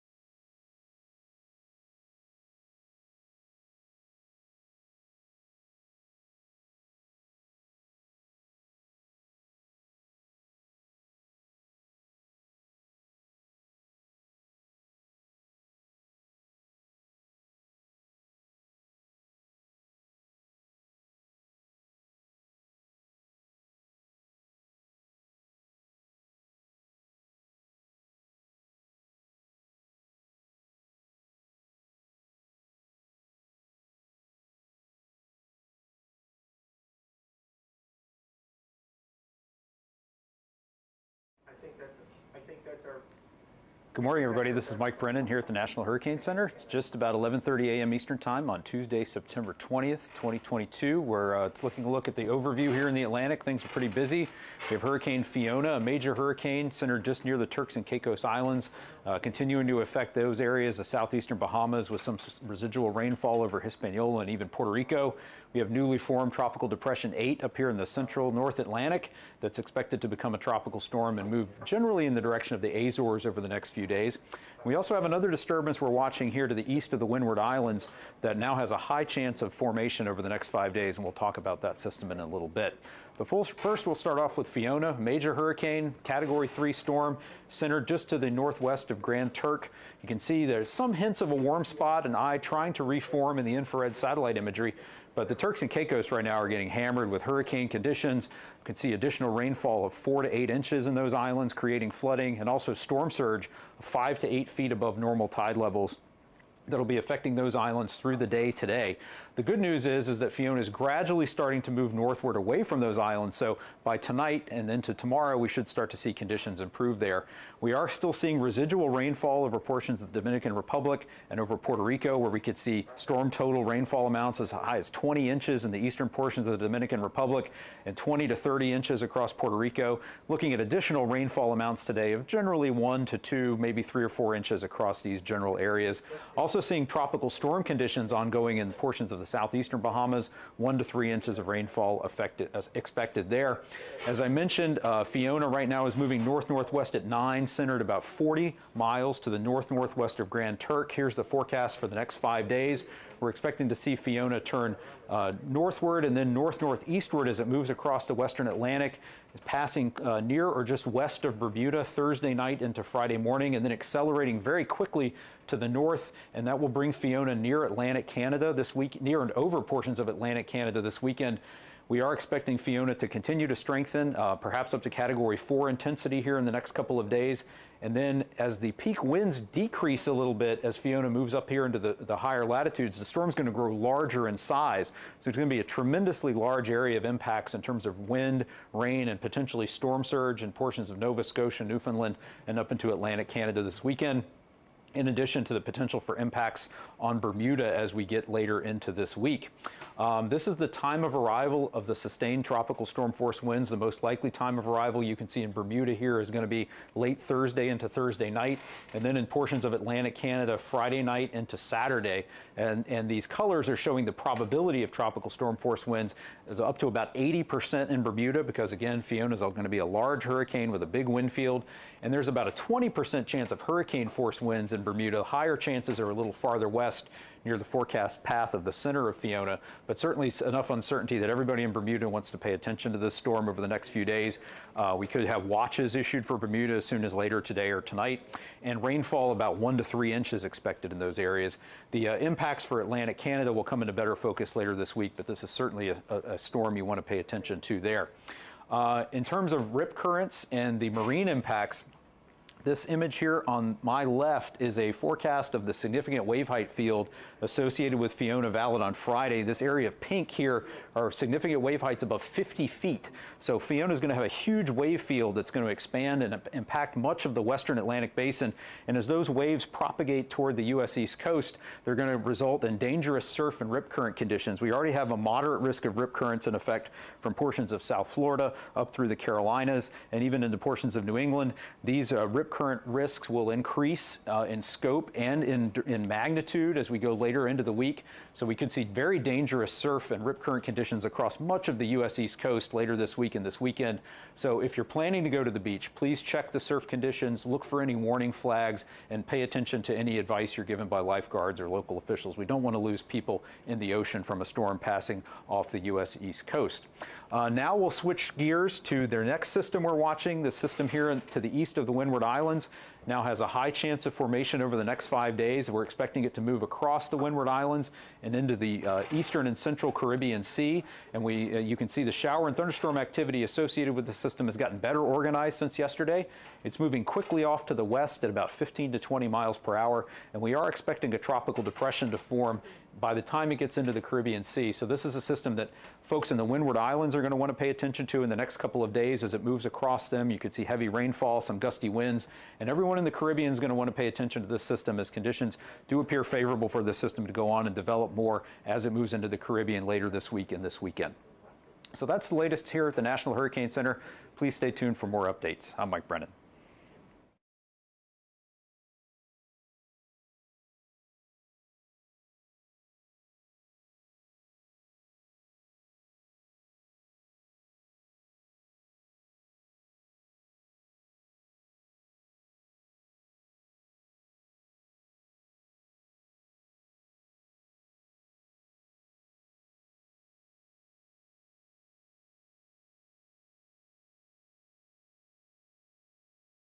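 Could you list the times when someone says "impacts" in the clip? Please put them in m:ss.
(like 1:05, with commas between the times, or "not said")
3:07, 3:16, 4:02, 4:11, 4:26.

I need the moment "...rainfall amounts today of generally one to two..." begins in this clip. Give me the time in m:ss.
2:11.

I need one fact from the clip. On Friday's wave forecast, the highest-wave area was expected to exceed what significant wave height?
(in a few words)
50 feet.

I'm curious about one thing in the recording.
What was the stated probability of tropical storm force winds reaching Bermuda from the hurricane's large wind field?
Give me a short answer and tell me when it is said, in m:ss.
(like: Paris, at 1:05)
80%, at 3:37.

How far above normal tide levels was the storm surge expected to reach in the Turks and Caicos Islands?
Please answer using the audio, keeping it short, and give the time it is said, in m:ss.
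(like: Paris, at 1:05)
5 to 8 feet, at 1:43.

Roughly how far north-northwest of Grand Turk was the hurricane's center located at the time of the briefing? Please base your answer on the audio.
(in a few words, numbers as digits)
40 miles.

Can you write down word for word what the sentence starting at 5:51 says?
So that's the latest here at the National Hurricane Center.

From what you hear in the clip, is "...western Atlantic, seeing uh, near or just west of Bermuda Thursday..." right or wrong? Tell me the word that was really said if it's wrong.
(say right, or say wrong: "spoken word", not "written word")
wrong: "passing", not "seeing".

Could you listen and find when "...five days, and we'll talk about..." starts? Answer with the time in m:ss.
1:20.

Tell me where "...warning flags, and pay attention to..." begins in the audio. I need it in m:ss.
4:57.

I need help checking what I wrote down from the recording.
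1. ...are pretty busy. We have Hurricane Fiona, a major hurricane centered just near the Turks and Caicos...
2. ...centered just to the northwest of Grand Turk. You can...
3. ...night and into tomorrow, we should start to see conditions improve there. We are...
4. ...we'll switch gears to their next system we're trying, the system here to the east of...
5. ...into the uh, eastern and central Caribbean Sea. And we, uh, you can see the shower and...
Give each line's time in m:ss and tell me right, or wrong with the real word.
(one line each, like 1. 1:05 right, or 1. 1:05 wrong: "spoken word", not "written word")
1. 0:53 right
2. 1:27 right
3. 1:53 wrong: "tonight", not "night"
4. 5:07 wrong: "watching", not "trying"
5. 5:18 right.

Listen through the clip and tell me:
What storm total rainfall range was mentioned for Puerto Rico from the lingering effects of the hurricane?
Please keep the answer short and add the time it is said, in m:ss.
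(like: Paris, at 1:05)
20 to 30 inches, at 2:07.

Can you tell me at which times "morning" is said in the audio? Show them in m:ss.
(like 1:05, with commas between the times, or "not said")
0:44, 2:43.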